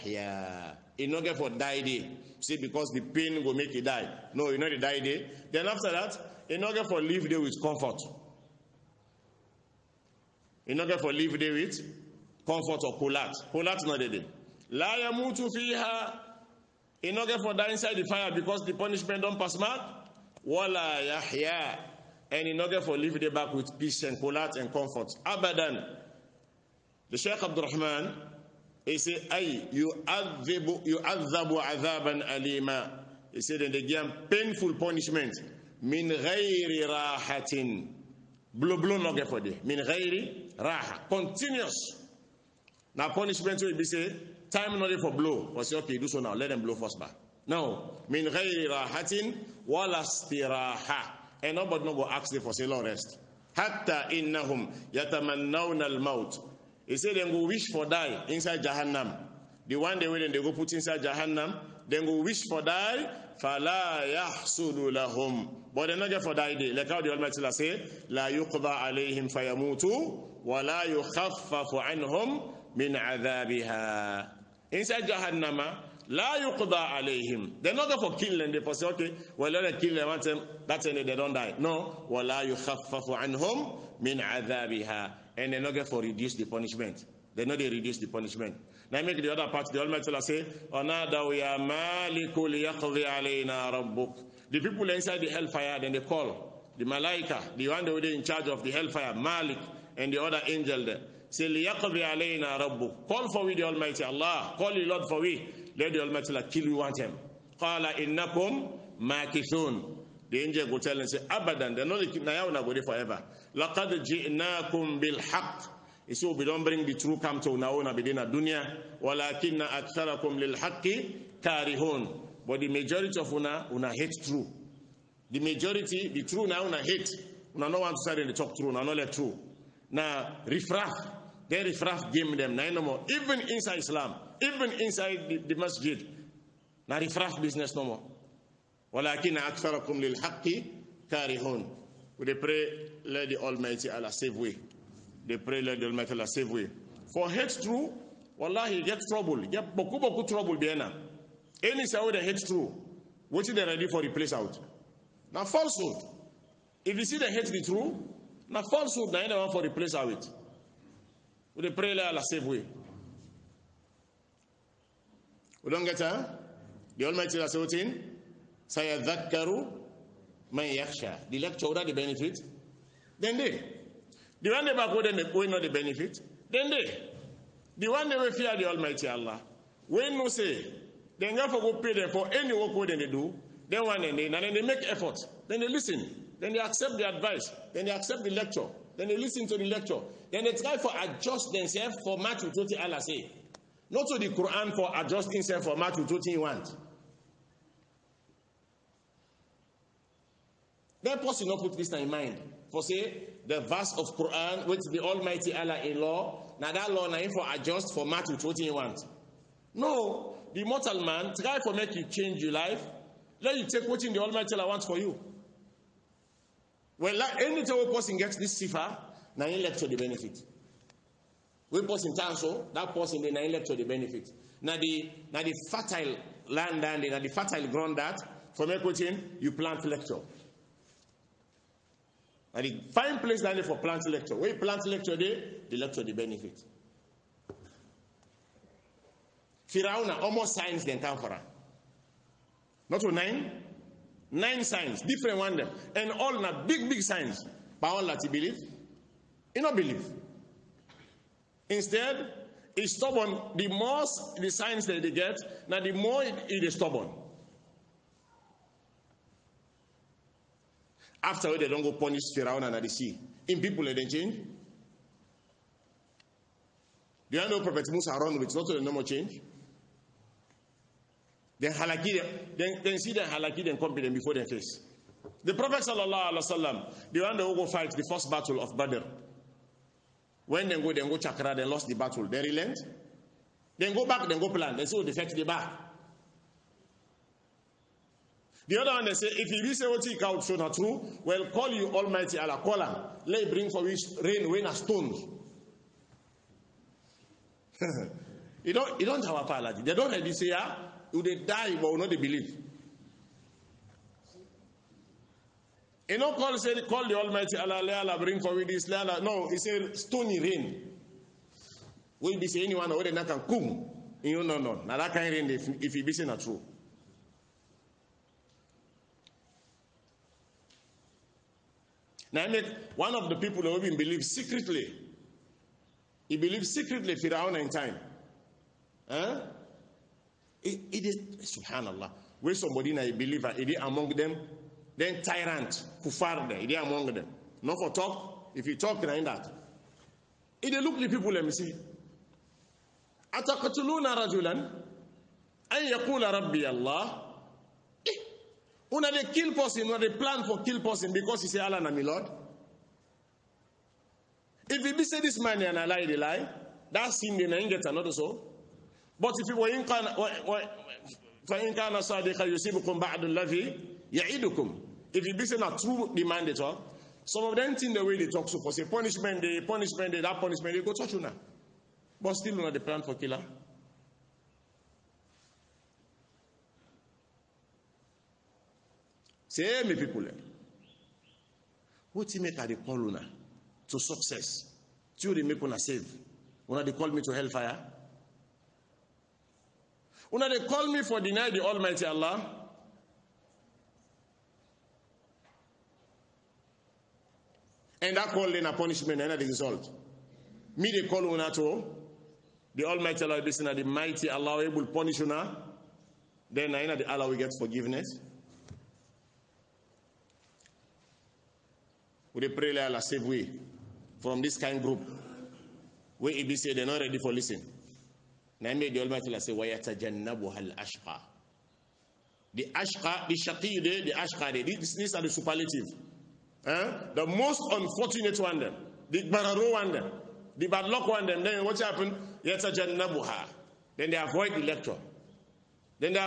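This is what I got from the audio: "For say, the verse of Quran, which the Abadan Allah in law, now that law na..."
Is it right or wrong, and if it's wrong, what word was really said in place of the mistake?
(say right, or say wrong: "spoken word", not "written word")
wrong: "Almighty", not "Abadan".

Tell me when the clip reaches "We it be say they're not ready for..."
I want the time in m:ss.
6:56.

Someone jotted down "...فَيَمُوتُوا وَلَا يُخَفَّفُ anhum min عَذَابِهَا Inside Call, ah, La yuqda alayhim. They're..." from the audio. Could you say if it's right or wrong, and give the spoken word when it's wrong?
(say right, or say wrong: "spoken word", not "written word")
wrong: "Jahannam", not "Call".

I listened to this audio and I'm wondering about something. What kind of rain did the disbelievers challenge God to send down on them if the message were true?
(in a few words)
Stony rain.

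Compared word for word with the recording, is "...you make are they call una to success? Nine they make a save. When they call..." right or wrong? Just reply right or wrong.
wrong.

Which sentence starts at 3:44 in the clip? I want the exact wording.
Now, the now the fertile land and na the fertile ground that from equating you plant lecture.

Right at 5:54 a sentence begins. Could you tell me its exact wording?
If we be say this man and I lie, they lie, that sin they na get another soul.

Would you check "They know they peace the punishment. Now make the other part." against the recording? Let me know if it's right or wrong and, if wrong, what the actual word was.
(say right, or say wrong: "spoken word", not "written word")
wrong: "reduce", not "peace".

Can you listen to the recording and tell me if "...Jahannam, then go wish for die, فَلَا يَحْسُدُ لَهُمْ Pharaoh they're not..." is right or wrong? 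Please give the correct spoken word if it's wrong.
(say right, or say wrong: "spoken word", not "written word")
wrong: "But", not "Pharaoh".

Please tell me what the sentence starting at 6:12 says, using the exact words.
But still not the plan for killer.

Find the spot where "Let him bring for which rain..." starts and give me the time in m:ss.
4:53.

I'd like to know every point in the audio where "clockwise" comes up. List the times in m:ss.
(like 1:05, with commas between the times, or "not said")
not said.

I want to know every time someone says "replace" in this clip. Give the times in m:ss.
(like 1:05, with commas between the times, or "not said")
2:34, 2:39.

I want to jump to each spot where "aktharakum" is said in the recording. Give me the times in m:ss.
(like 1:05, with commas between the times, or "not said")
1:59, 2:19.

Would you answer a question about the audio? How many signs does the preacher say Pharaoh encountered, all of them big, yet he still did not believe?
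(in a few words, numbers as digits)
9.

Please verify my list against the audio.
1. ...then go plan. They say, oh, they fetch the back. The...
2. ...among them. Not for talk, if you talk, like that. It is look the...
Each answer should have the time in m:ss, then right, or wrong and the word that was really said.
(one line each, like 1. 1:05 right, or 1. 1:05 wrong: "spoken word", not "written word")
1. 4:44 right
2. 5:36 right.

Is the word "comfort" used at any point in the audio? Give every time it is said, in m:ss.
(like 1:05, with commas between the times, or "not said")
0:07, 0:12, 0:24.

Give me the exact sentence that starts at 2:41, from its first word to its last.
With the prayer Allah save way.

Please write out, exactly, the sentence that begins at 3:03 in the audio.
Then one and then, and then they make effort.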